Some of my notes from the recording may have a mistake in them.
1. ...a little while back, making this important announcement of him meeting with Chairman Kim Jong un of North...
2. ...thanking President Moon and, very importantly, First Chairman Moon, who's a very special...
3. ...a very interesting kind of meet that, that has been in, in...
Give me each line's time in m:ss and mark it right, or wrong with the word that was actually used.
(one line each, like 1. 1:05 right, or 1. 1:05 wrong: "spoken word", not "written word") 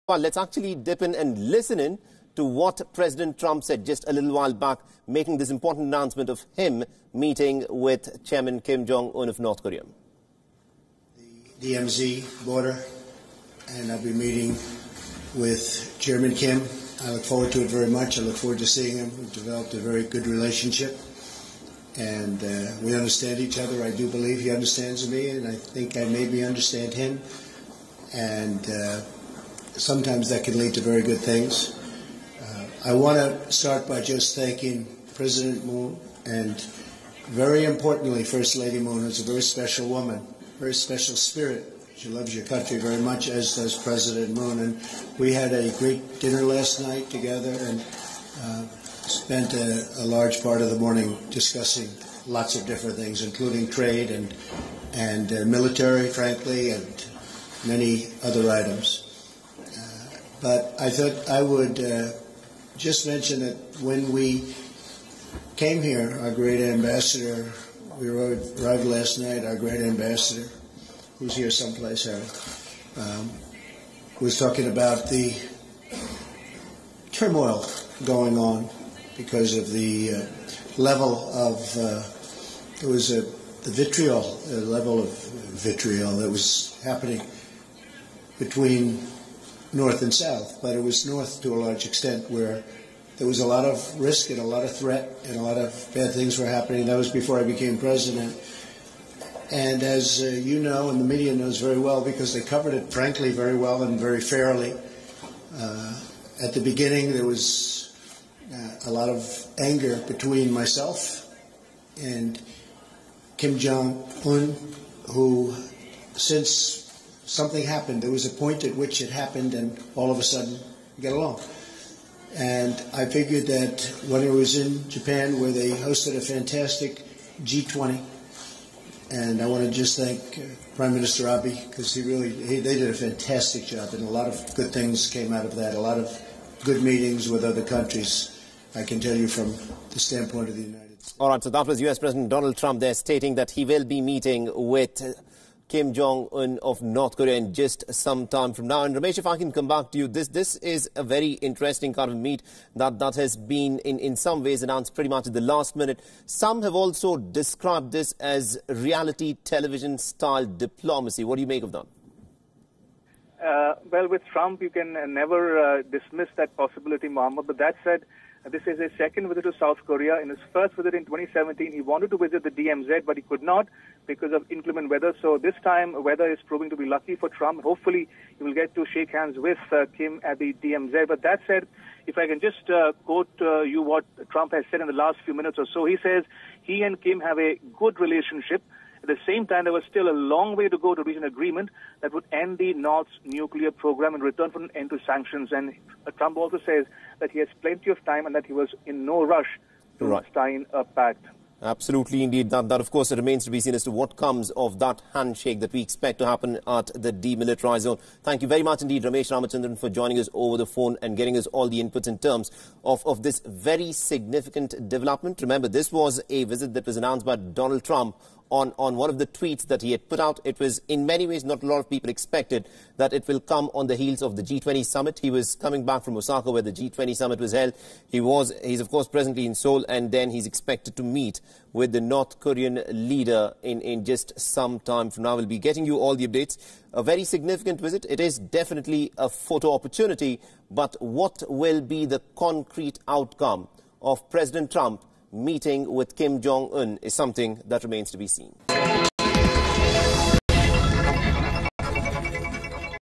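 1. 0:04 right
2. 0:34 wrong: "Lady", not "Chairman"
3. 2:30 right.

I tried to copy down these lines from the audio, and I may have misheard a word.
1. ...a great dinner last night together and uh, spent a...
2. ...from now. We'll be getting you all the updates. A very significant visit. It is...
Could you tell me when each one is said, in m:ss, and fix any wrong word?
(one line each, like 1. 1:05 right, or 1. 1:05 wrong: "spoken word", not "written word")
1. 0:45 right
2. 3:55 right.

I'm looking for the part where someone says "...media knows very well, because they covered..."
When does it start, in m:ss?
1:41.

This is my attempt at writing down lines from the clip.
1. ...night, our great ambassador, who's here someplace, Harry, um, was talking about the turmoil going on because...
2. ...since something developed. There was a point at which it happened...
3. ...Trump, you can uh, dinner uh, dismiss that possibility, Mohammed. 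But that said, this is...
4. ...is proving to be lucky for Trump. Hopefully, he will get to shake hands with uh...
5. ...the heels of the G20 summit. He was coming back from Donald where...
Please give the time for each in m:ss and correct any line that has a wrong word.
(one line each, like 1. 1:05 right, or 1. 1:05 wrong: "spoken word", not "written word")
1. 1:09 right
2. 1:56 wrong: "happened", not "developed"
3. 2:44 wrong: "never", not "dinner"
4. 2:56 right
5. 3:43 wrong: "Osaka", not "Donald".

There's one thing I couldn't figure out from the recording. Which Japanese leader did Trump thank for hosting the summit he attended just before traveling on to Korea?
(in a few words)
Prime Minister Abe.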